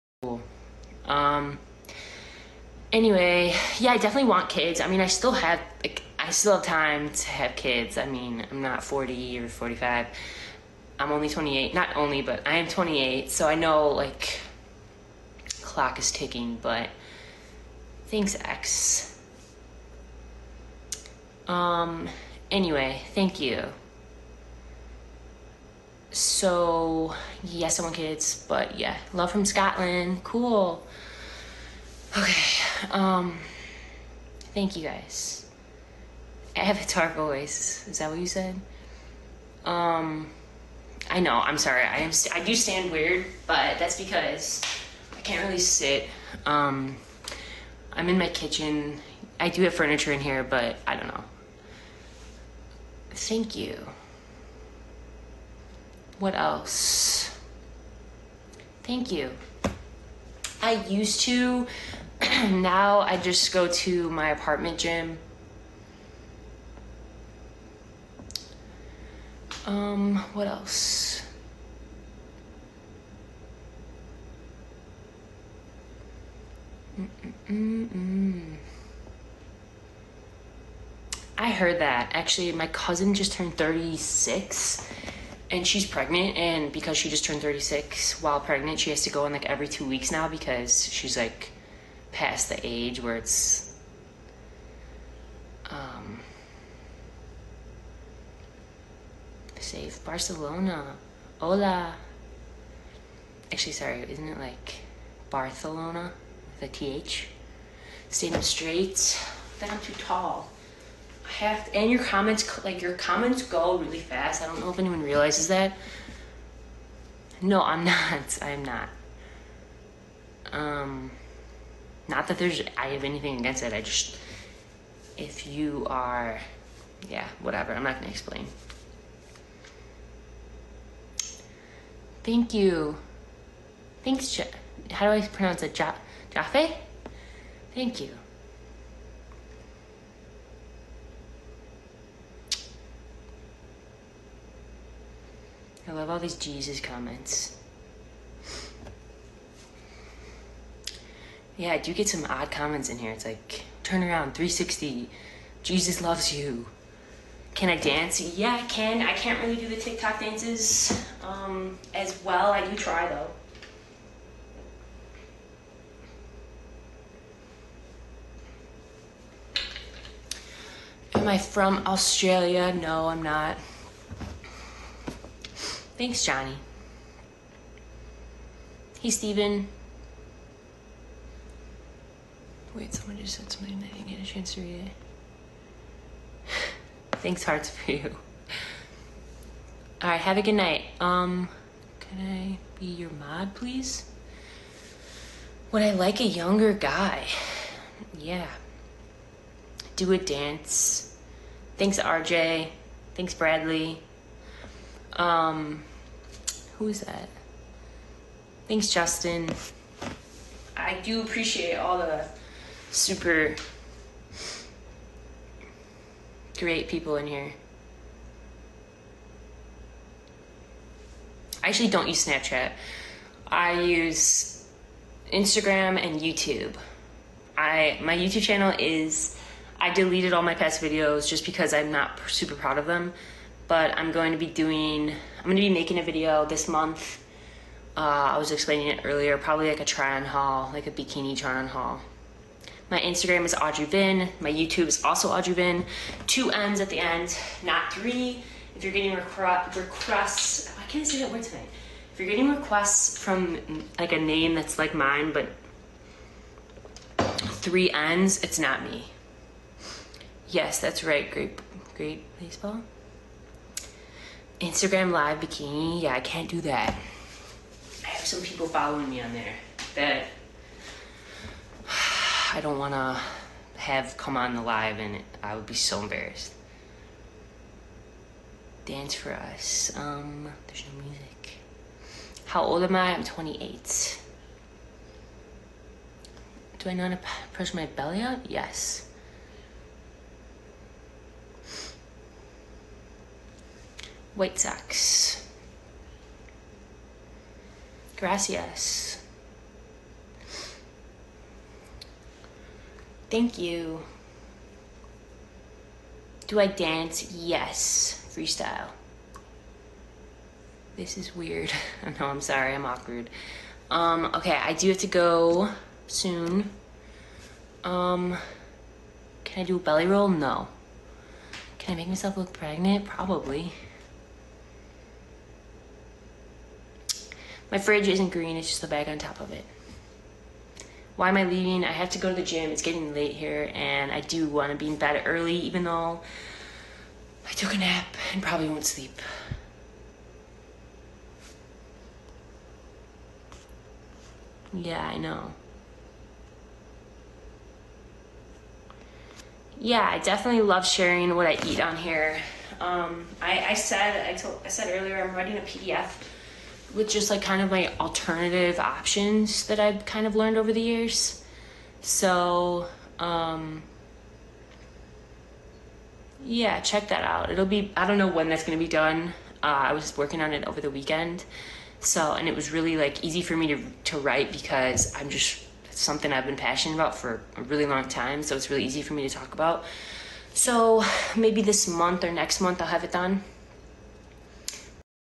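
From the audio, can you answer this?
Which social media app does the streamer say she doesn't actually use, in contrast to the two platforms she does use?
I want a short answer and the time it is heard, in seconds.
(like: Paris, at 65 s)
Snapchat, at 222 s.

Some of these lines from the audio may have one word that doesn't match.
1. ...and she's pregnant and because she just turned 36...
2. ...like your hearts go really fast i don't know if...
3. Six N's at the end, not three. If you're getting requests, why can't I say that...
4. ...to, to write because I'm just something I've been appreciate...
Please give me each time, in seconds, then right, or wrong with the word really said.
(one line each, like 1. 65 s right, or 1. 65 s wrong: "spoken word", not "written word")
1. 85 s right
2. 112 s wrong: "comments", not "hearts"
3. 246 s wrong: "Two", not "Six"
4. 373 s wrong: "passionate", not "appreciate".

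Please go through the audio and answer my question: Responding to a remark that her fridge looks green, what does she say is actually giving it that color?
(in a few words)
The bag on top.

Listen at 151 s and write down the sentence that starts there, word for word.
Yeah, I do get some odd comments in here.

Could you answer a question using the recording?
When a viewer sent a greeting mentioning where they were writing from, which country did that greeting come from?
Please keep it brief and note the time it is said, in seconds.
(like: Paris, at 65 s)
Scotland, at 29 s.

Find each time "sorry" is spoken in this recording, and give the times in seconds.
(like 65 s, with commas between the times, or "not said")
41 s, 103 s, 312 s.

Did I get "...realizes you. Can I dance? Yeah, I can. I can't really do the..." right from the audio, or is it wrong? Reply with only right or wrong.
wrong.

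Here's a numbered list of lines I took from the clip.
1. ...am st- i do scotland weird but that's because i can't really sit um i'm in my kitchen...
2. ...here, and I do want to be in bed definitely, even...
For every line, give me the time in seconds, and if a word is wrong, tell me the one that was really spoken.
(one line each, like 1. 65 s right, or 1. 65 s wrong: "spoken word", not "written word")
1. 41 s wrong: "stand", not "scotland"
2. 333 s wrong: "early", not "definitely".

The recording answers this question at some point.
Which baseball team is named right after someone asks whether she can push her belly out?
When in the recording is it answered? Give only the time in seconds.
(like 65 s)
294 s.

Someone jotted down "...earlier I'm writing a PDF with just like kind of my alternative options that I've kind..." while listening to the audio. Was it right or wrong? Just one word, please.
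right.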